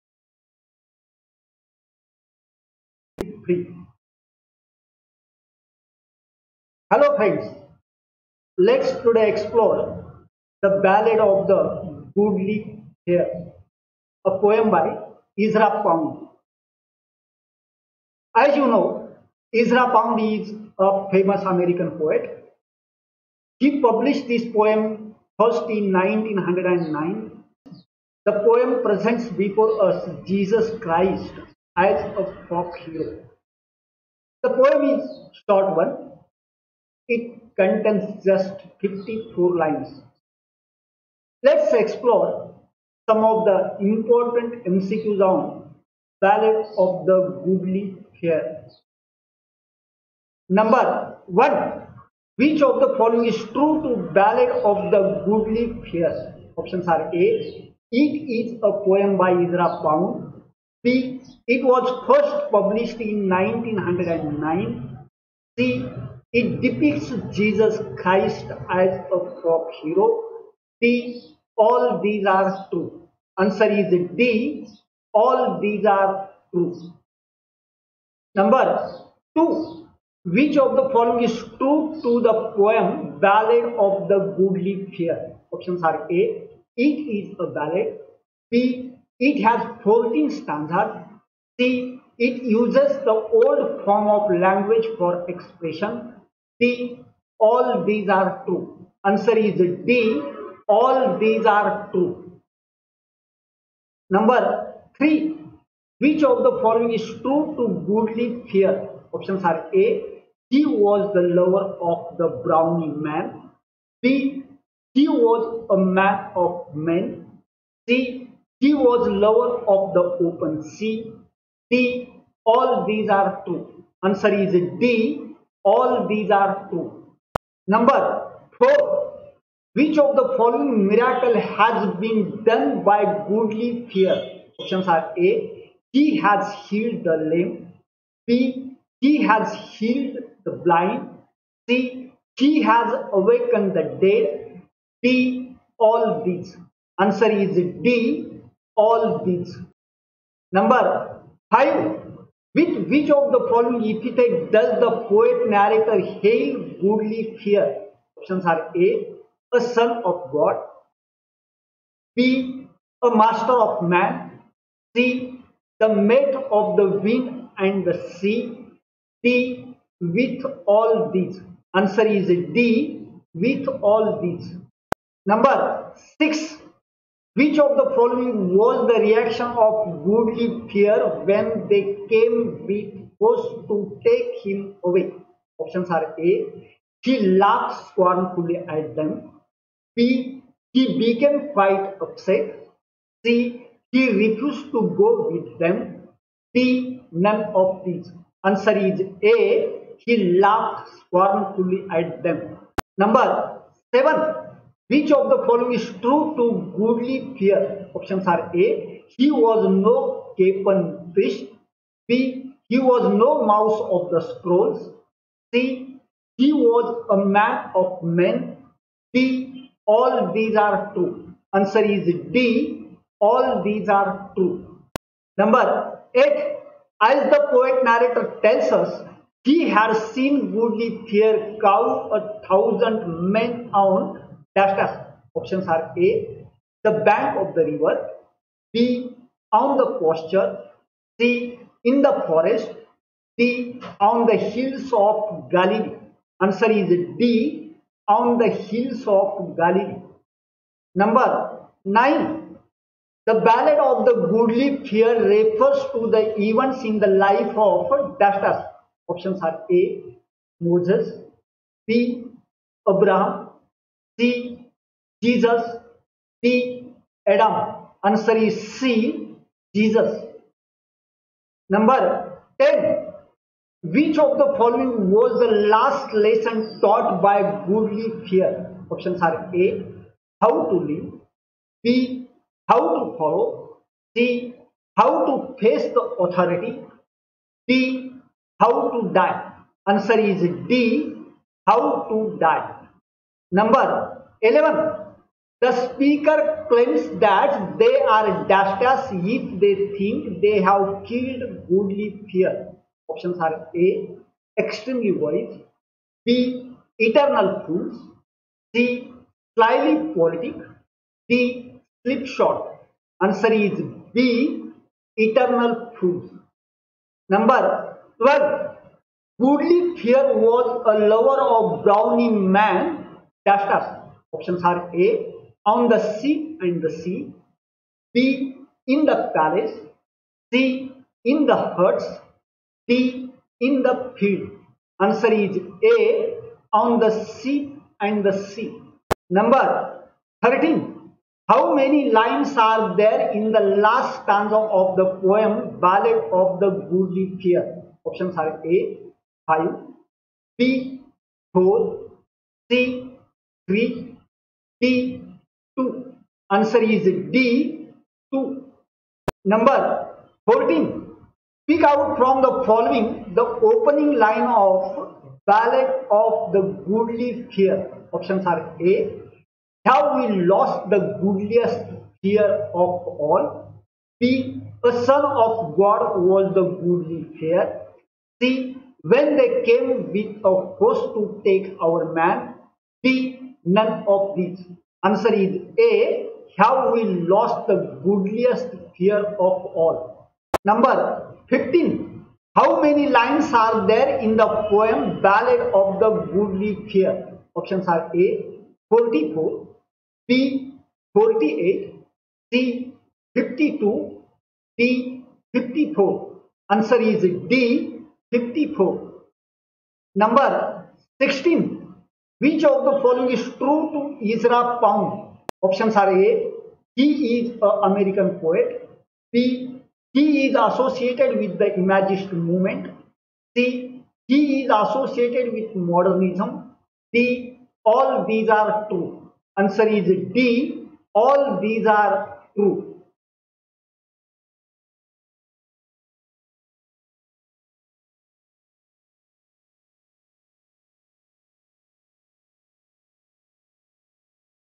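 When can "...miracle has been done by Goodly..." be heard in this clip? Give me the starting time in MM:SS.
02:10.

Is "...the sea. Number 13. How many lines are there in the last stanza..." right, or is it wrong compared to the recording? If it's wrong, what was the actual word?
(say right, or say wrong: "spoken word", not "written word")
right.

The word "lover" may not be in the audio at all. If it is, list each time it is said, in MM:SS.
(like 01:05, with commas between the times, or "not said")
01:51, 01:59, 05:21.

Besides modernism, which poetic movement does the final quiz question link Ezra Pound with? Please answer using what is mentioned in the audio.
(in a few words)
Imagist movement.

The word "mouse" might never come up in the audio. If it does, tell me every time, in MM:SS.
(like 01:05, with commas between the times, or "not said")
03:33.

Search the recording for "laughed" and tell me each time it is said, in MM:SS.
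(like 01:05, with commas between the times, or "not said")
03:07, 03:20.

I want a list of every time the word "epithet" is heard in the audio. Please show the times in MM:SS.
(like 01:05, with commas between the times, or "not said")
02:33.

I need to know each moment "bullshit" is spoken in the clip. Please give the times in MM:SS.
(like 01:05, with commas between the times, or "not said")
not said.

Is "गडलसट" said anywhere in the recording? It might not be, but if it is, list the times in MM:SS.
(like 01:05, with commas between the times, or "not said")
06:28.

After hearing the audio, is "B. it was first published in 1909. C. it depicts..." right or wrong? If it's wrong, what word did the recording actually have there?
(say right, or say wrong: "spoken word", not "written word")
right.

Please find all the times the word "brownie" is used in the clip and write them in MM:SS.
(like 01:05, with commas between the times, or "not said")
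01:52, 05:21.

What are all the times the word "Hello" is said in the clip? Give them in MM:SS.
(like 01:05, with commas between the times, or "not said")
00:06.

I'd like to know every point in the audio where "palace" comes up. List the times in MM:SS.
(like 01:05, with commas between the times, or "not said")
05:29.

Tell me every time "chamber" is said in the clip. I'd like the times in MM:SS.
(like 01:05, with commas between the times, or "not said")
not said.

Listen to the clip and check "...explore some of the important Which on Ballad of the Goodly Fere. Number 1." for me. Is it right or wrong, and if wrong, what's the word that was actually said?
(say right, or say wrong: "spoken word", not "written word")
wrong: "MCQs", not "Which".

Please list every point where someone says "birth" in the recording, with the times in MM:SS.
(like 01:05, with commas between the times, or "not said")
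not said.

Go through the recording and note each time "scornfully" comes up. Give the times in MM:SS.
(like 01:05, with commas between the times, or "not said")
03:07, 03:20.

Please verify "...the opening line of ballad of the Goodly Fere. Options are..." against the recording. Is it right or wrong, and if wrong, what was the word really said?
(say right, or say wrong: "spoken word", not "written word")
right.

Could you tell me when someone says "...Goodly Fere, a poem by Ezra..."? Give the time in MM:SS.
00:12.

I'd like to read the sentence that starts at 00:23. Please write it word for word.
He published this poem first in 1909 the poem presents before us Jesus Christ as a folk hero.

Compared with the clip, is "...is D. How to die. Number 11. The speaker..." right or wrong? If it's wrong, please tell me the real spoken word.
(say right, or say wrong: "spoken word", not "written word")
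right.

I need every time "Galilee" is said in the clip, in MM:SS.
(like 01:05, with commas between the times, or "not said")
04:05, 04:09.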